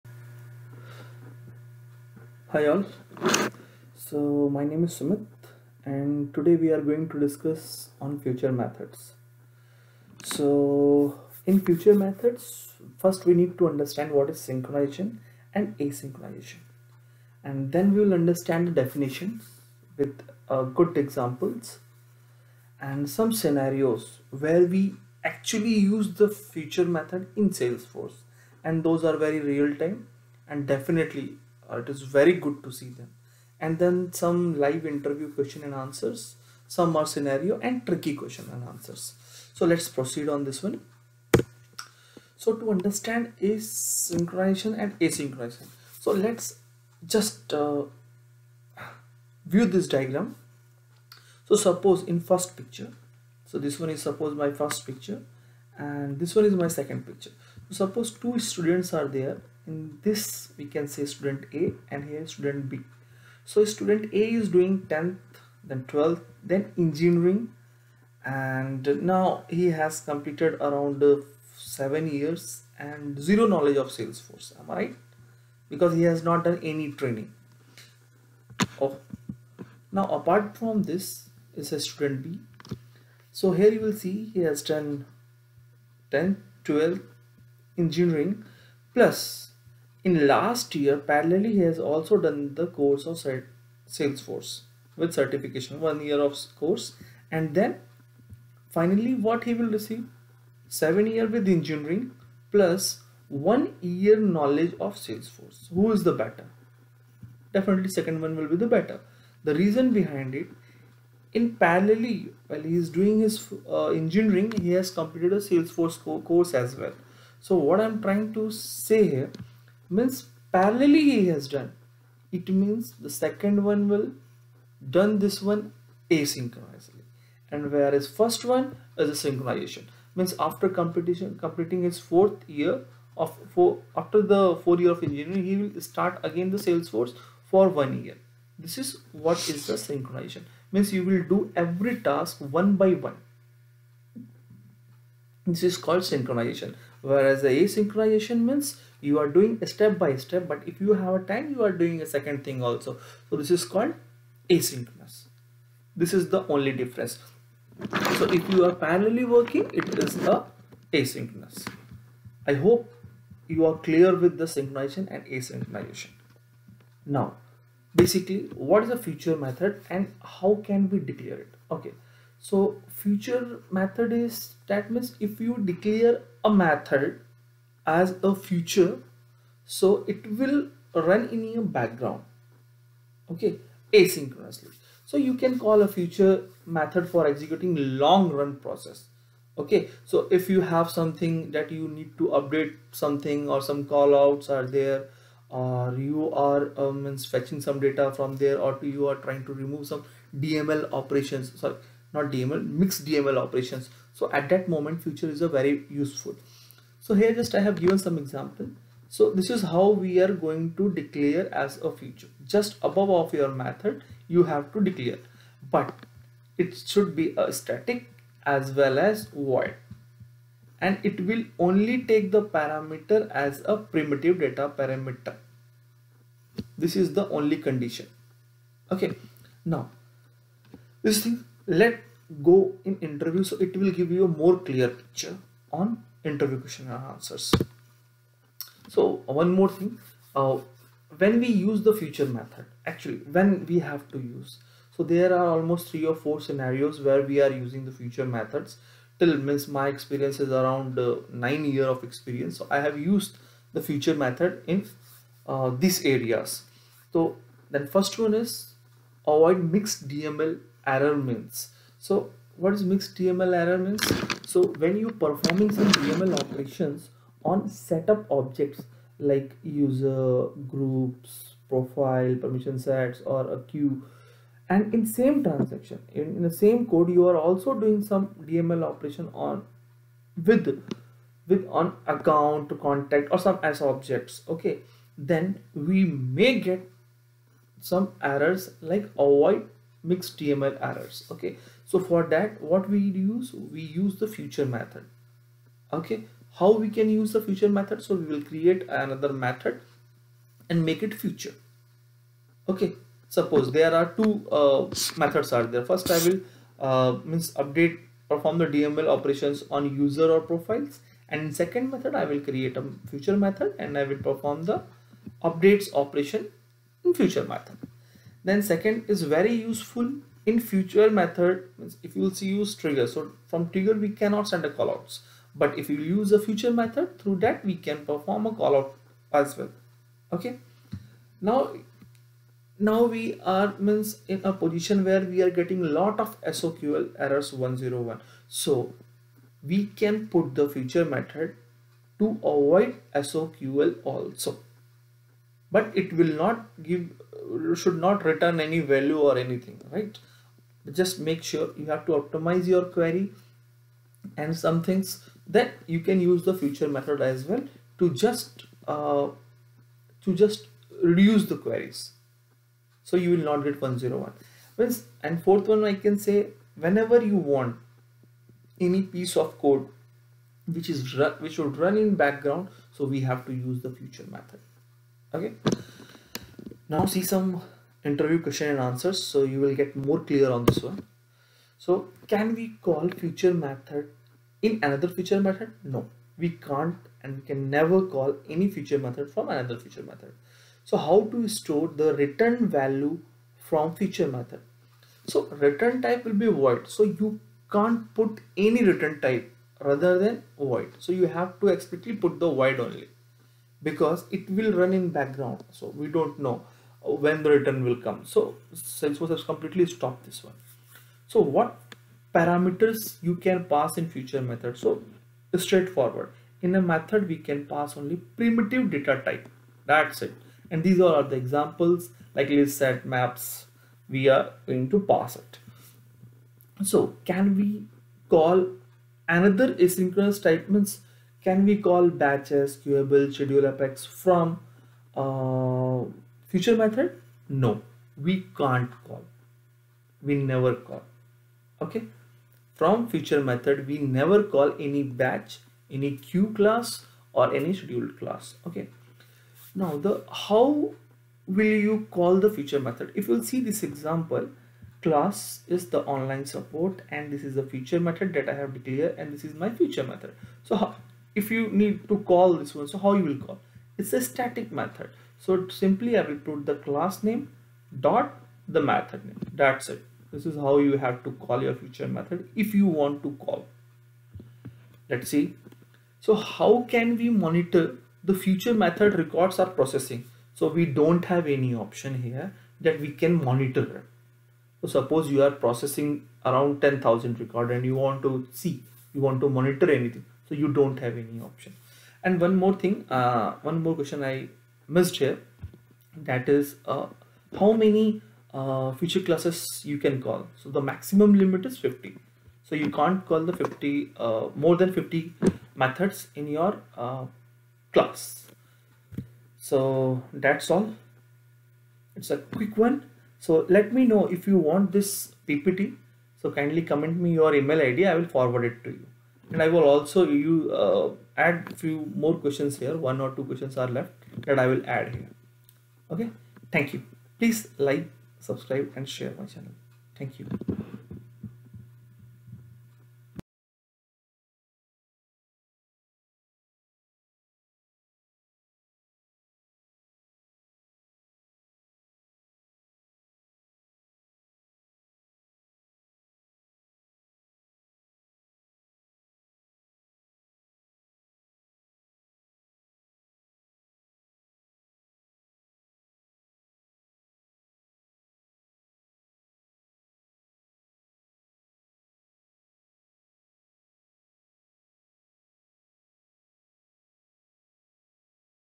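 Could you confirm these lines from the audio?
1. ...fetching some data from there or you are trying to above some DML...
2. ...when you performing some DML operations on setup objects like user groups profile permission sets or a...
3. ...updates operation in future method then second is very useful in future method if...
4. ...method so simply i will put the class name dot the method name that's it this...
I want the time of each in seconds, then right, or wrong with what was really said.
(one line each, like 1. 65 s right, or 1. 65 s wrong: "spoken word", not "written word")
1. 197 s wrong: "remove", not "above"
2. 264 s right
3. 315 s right
4. 464 s right.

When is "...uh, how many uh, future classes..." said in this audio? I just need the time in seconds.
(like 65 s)
496 s.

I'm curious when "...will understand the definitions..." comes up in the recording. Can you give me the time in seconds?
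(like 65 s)
18 s.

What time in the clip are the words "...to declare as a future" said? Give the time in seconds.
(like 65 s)
210 s.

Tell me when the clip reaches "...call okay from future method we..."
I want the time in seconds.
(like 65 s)
440 s.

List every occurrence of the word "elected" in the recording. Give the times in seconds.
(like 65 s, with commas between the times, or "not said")
not said.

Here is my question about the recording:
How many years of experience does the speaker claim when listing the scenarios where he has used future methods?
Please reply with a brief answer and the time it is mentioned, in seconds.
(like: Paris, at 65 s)
9, at 251 s.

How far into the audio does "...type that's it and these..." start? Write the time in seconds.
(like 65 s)
419 s.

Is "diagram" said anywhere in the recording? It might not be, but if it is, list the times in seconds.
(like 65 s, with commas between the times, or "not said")
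49 s.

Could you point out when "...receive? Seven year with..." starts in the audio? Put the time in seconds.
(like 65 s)
99 s.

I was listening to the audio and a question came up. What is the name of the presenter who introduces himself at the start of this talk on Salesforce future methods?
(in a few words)
Sumit.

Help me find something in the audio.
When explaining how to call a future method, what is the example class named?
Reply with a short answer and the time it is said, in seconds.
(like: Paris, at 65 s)
online support, at 456 s.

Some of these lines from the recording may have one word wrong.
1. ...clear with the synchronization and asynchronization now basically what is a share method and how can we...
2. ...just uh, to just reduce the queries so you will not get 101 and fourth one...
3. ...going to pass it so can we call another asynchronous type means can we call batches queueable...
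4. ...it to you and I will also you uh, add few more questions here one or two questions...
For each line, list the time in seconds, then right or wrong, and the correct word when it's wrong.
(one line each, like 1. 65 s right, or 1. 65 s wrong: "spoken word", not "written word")
1. 163 s wrong: "future", not "share"
2. 358 s right
3. 424 s right
4. 518 s right.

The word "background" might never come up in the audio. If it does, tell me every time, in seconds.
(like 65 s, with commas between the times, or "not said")
181 s, 372 s, 405 s.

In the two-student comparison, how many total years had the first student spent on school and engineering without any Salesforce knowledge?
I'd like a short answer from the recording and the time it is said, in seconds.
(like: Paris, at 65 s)
7, at 71 s.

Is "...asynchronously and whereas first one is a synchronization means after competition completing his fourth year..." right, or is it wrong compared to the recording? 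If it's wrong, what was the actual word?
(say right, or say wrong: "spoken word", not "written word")
right.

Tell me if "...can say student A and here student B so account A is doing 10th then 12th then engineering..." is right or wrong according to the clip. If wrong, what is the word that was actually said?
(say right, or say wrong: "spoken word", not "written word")
wrong: "student", not "account".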